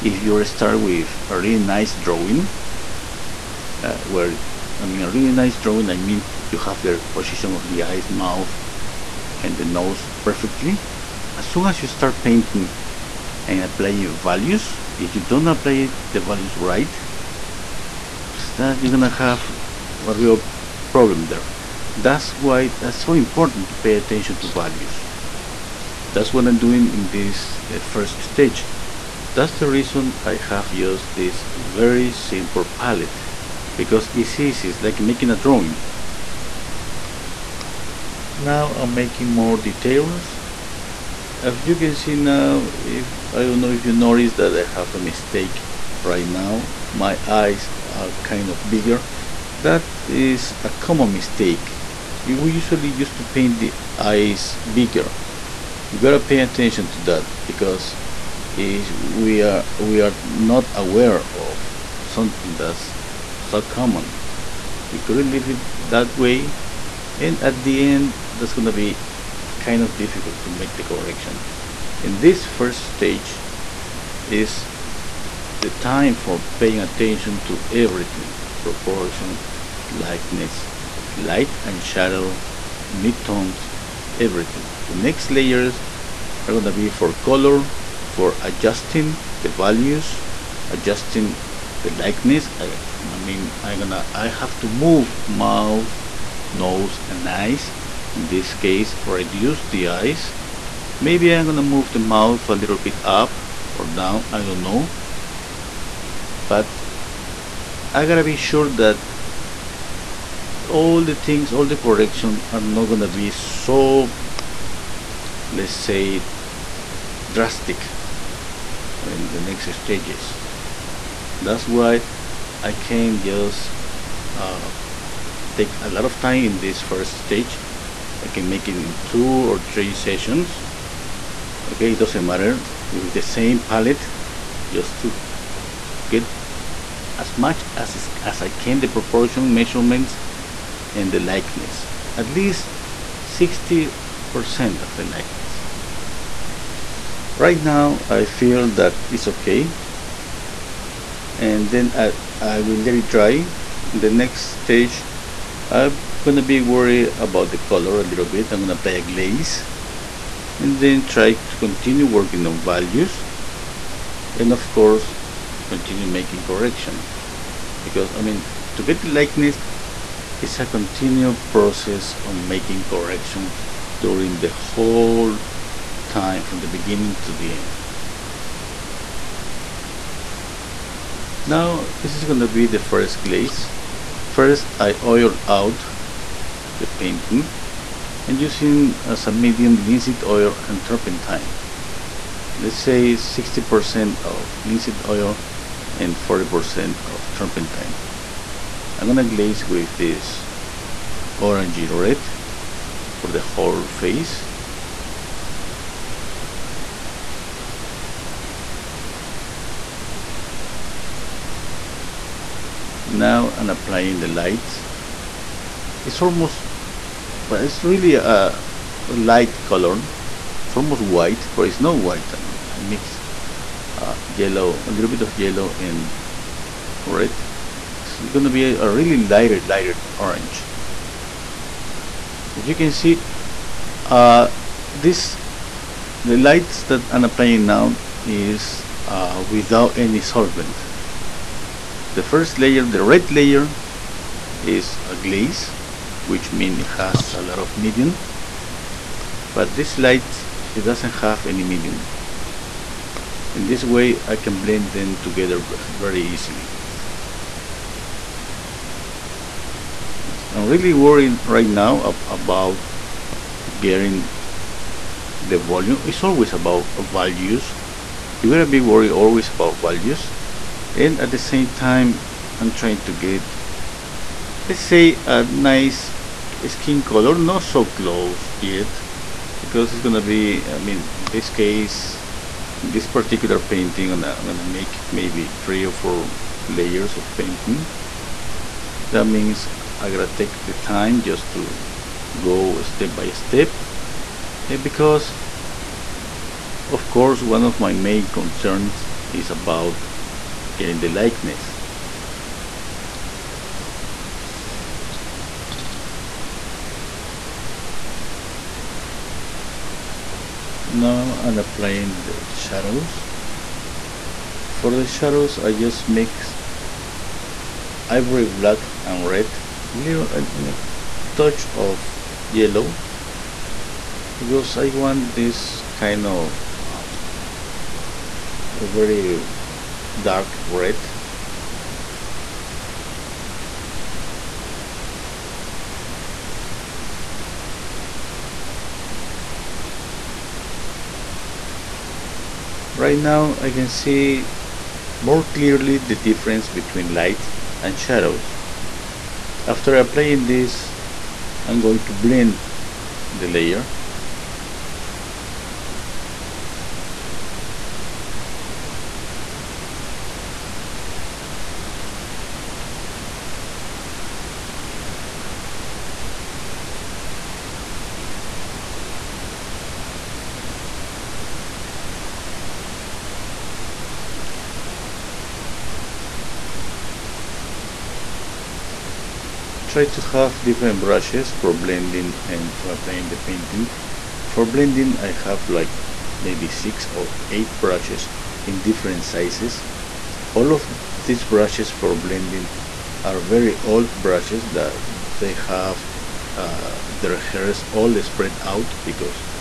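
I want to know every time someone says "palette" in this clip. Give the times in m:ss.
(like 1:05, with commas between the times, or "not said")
0:32, 2:13.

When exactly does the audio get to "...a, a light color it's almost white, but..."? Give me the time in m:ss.
3:38.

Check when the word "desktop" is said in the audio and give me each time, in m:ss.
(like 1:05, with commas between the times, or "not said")
not said.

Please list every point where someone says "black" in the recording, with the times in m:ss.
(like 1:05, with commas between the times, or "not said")
5:18.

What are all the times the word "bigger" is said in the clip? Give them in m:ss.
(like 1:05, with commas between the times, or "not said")
0:48, 0:54.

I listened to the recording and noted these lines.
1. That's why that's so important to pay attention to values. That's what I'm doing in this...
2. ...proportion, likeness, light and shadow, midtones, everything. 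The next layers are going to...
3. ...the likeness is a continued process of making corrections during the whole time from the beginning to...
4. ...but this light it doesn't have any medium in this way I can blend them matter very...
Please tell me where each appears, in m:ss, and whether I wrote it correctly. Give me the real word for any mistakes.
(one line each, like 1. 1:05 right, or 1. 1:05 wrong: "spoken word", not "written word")
1. 0:21 right
2. 1:18 right
3. 2:49 right
4. 4:09 wrong: "together", not "matter".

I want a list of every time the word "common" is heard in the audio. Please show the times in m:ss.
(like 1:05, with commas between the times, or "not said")
0:50, 1:03.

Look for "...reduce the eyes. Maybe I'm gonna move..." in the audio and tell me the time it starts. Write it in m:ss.
1:39.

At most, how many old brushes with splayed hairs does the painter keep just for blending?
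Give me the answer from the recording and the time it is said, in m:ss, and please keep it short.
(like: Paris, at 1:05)
8, at 6:26.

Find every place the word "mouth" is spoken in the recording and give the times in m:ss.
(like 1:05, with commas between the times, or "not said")
0:08, 1:35, 1:42.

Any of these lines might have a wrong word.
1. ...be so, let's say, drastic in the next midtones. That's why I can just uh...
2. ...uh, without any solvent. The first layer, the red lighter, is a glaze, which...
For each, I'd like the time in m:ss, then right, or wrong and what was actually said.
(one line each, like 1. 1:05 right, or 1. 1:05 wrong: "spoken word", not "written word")
1. 1:53 wrong: "stages", not "midtones"
2. 3:59 wrong: "layer", not "lighter".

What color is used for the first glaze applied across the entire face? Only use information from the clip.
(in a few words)
Orangey red.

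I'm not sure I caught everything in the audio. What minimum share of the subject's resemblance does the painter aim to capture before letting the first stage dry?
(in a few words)
60%.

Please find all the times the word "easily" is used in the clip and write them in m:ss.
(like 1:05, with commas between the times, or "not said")
4:16.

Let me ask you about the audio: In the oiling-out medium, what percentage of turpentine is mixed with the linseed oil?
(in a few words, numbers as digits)
40%.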